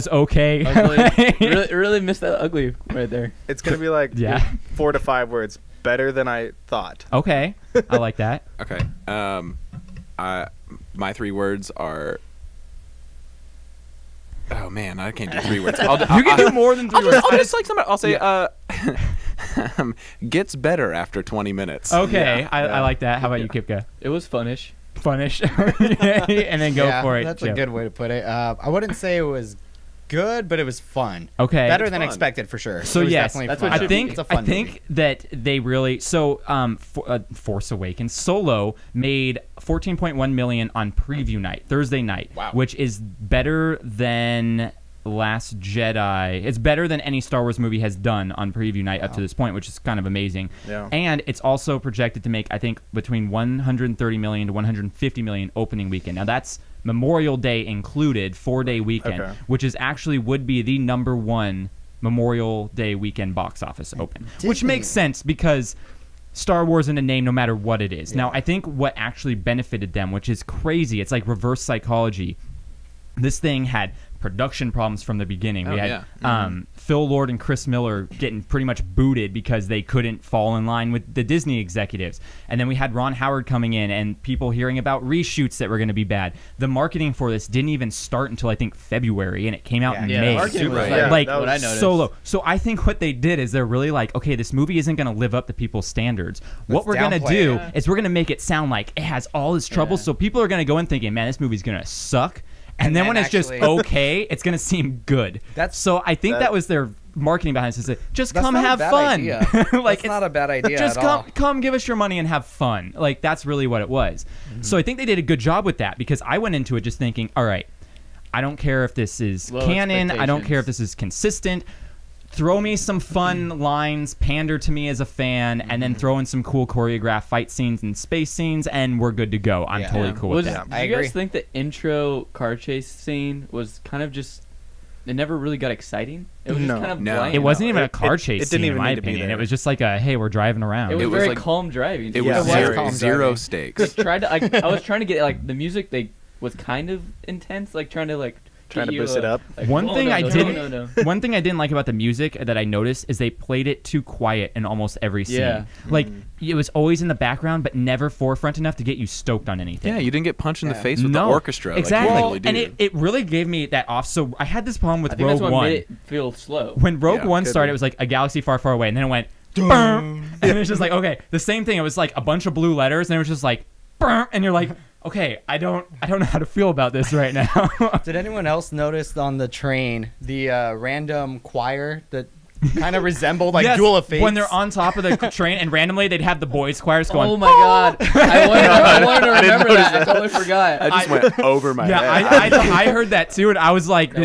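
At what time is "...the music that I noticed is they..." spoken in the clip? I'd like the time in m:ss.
2:31.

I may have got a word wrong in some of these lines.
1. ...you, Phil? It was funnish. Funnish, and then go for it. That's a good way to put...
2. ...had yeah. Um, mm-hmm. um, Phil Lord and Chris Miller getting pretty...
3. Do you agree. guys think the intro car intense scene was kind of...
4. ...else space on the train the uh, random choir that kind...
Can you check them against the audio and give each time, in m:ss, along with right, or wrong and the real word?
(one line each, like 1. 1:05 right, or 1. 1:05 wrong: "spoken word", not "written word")
1. 0:23 wrong: "Kipka", not "Phil"
2. 1:15 right
3. 2:10 wrong: "chase", not "intense"
4. 2:58 wrong: "notice", not "space".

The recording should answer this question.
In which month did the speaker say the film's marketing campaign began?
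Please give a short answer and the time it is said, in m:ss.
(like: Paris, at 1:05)
February, at 1:28.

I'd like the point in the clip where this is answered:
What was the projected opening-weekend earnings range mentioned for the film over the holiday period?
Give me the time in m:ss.
0:53.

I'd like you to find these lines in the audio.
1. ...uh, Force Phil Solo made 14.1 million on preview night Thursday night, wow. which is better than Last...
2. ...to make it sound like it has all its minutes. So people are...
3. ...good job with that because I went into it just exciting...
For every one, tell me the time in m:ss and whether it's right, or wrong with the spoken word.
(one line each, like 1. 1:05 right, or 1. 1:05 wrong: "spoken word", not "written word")
1. 0:37 wrong: "Awakens", not "Phil"
2. 1:38 wrong: "troubles", not "minutes"
3. 1:55 wrong: "thinking", not "exciting".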